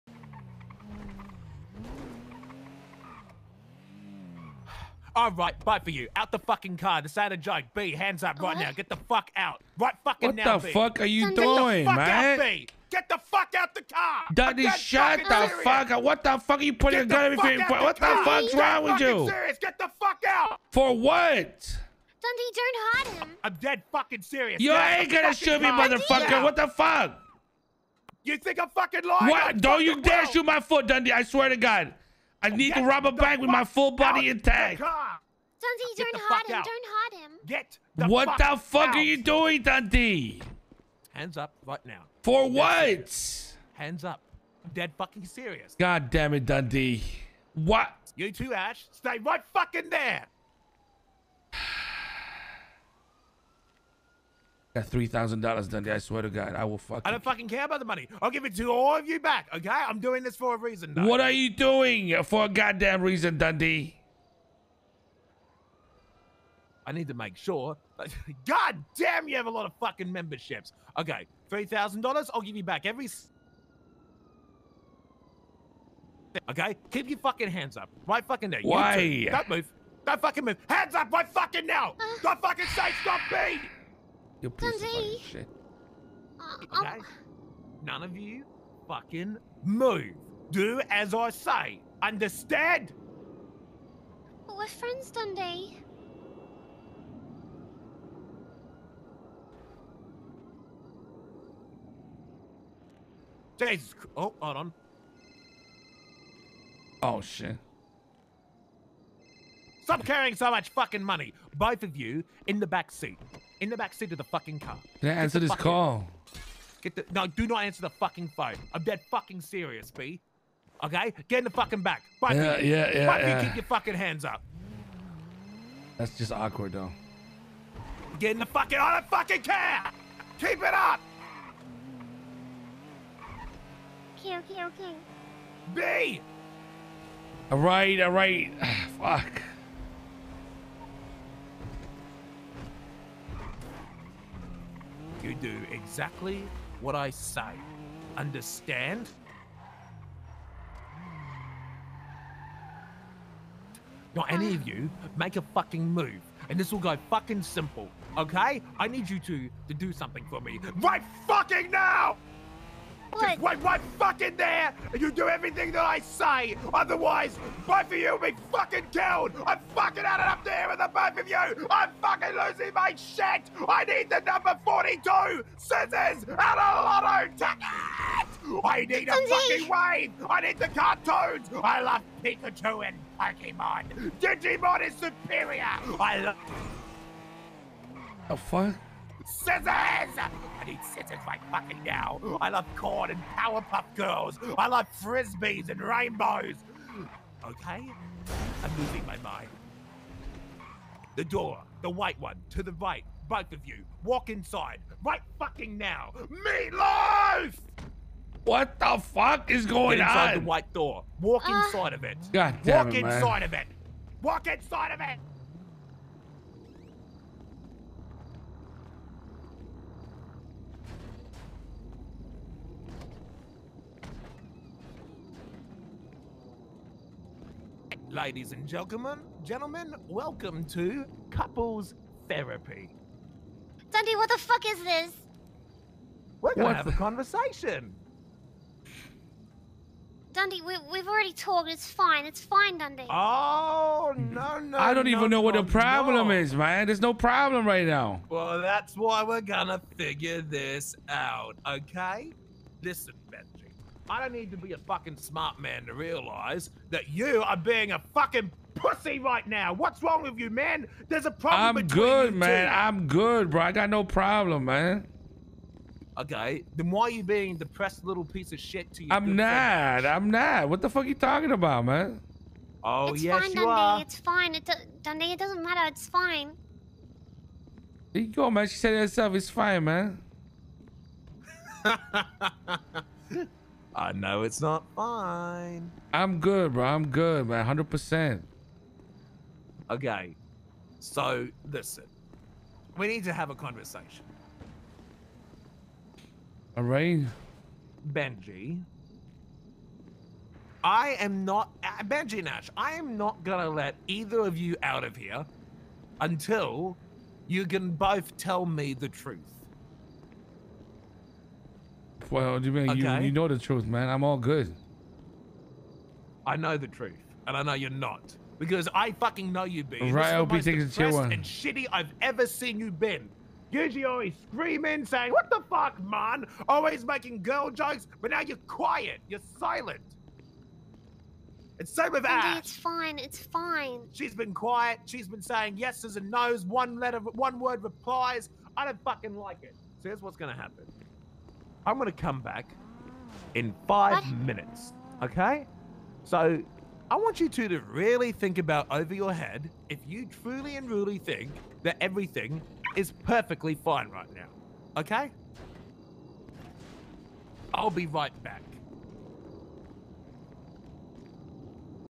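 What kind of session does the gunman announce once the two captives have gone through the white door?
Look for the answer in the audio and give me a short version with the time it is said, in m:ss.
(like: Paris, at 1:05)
Couples therapy, at 3:51.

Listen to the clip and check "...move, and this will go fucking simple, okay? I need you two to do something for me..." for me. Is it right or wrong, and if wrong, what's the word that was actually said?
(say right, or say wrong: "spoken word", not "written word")
right.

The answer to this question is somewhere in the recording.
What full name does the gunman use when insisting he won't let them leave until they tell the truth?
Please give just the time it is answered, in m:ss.
5:02.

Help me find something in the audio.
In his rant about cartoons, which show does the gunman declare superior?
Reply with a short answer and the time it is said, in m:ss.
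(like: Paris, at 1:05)
Digimon, at 3:04.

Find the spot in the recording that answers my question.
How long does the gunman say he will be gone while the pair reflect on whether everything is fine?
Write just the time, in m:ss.
5:43.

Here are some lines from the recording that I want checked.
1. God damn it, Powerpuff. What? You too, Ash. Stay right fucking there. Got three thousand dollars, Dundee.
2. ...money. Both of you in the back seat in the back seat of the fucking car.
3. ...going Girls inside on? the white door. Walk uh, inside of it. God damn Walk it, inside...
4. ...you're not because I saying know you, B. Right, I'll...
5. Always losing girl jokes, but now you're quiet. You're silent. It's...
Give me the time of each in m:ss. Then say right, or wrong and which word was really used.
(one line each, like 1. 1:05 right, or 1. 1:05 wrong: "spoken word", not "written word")
1. 0:45 wrong: "Dundee", not "Powerpuff"
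2. 1:51 right
3. 3:29 wrong: "Get", not "Girls"
4. 5:17 wrong: "fucking", not "saying"
5. 5:26 wrong: "making", not "losing".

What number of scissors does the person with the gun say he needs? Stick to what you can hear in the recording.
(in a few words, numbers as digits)
42.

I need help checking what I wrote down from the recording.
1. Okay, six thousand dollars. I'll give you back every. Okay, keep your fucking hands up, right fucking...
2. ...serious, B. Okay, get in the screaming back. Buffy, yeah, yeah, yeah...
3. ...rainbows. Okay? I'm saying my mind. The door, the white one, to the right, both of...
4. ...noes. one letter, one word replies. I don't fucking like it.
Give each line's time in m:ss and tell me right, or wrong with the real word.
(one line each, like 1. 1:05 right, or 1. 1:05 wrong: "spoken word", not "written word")
1. 1:10 wrong: "three", not "six"
2. 1:59 wrong: "fucking", not "screaming"
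3. 3:15 wrong: "losing", not "saying"
4. 5:36 right.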